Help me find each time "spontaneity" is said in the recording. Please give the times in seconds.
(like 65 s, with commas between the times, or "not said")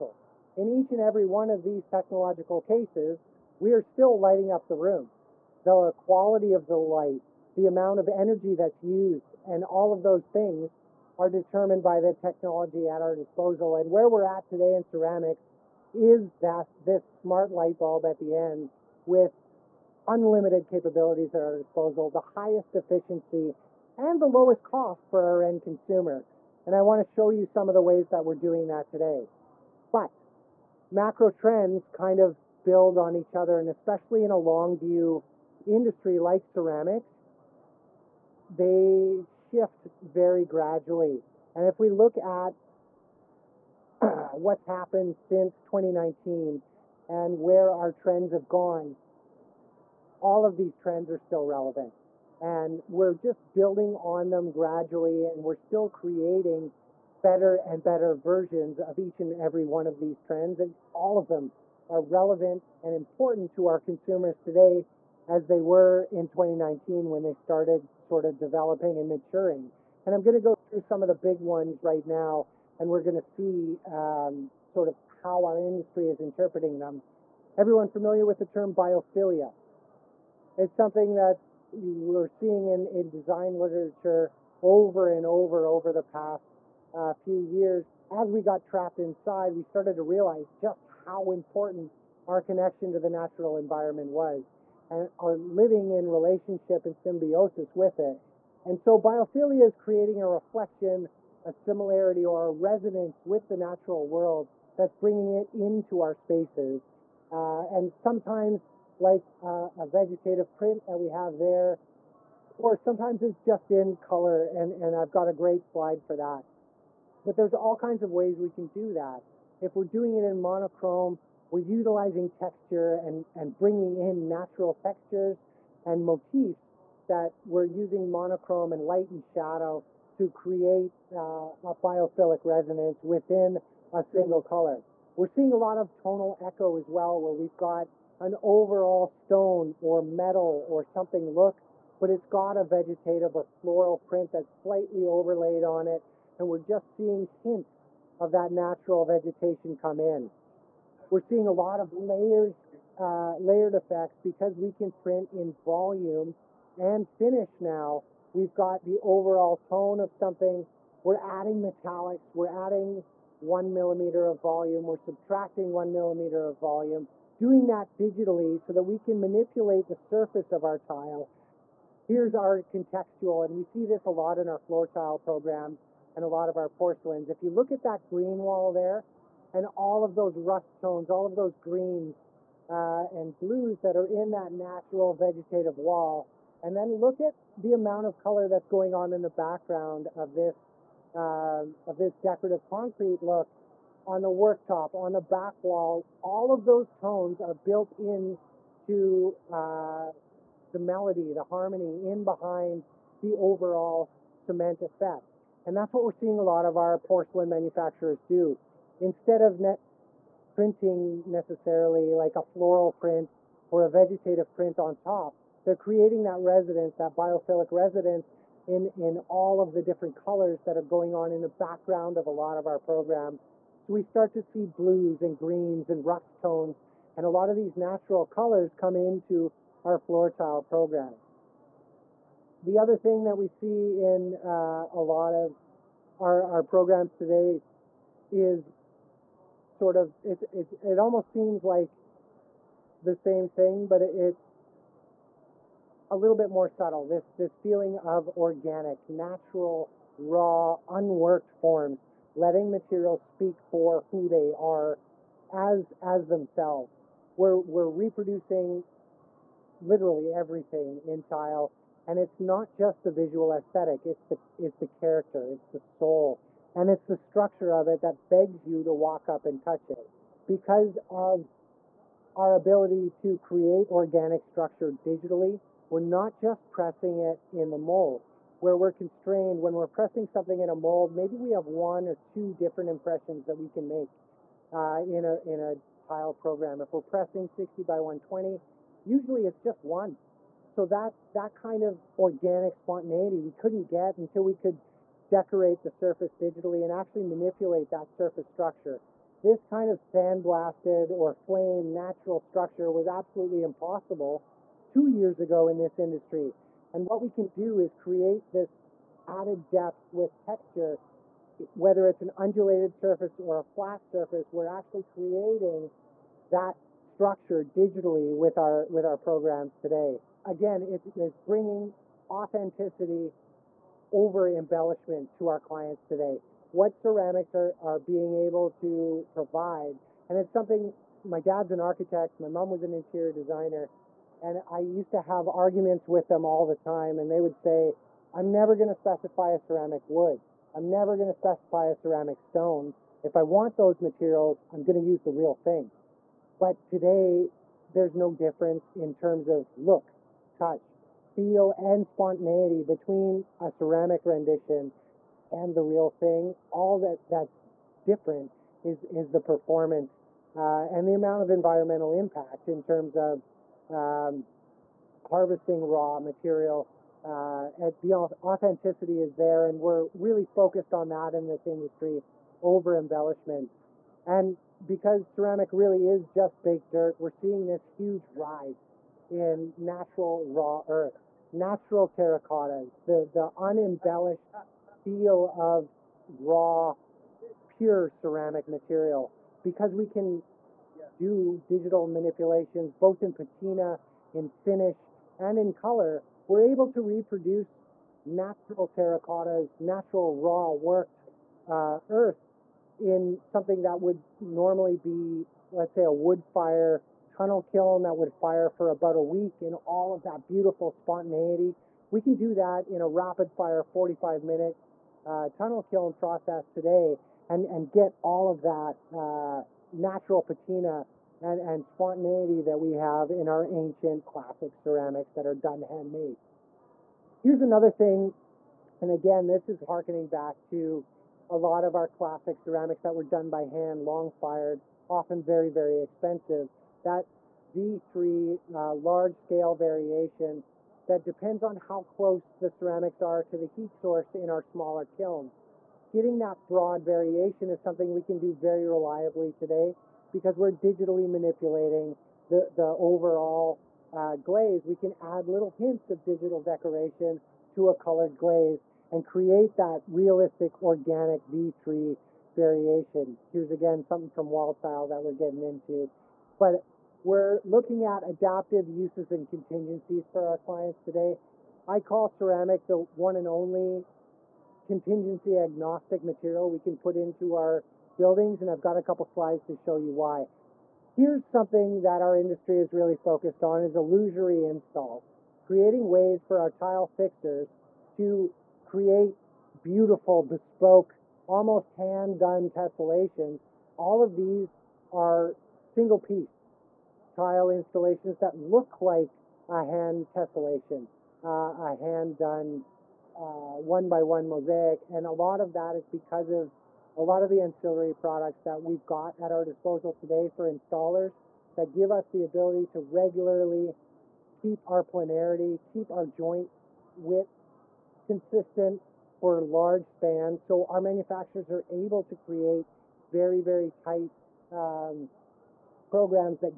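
292 s, 352 s, 410 s, 421 s.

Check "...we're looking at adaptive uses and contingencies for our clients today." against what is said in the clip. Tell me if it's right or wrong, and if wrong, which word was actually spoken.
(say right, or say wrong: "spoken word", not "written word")
right.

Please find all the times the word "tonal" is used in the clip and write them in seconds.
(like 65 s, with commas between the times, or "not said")
135 s.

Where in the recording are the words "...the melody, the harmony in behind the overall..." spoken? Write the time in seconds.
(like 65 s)
200 s.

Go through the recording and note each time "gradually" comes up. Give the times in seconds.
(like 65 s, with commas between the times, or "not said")
40 s, 54 s.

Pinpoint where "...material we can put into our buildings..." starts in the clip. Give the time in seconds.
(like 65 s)
476 s.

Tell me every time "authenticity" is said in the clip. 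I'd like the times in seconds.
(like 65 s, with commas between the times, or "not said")
322 s, 368 s.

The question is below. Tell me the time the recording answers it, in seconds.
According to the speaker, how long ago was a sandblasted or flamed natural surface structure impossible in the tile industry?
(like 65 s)
304 s.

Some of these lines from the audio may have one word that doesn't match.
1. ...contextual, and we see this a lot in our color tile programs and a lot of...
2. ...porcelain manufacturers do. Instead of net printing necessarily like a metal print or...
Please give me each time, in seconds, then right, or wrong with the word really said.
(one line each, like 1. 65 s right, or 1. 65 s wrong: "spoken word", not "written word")
1. 172 s wrong: "floor", not "color"
2. 206 s wrong: "floral", not "metal".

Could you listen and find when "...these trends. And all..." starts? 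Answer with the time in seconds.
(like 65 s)
59 s.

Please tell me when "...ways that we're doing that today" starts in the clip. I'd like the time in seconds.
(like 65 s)
27 s.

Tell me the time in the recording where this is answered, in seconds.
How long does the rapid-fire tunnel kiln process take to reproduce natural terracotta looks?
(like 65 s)
413 s.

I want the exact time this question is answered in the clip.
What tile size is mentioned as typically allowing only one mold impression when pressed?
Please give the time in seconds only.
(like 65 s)
287 s.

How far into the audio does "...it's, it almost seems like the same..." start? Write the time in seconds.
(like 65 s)
240 s.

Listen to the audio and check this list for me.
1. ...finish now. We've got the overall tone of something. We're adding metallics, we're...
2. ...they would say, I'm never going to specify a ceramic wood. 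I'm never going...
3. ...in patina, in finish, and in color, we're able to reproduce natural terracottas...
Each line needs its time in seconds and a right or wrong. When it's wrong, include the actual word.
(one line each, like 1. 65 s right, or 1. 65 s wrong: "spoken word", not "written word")
1. 157 s right
2. 337 s right
3. 393 s right.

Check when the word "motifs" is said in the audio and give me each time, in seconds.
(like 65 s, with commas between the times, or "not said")
126 s.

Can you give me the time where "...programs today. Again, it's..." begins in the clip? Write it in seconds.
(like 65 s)
319 s.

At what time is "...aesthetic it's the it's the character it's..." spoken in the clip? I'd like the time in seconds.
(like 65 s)
263 s.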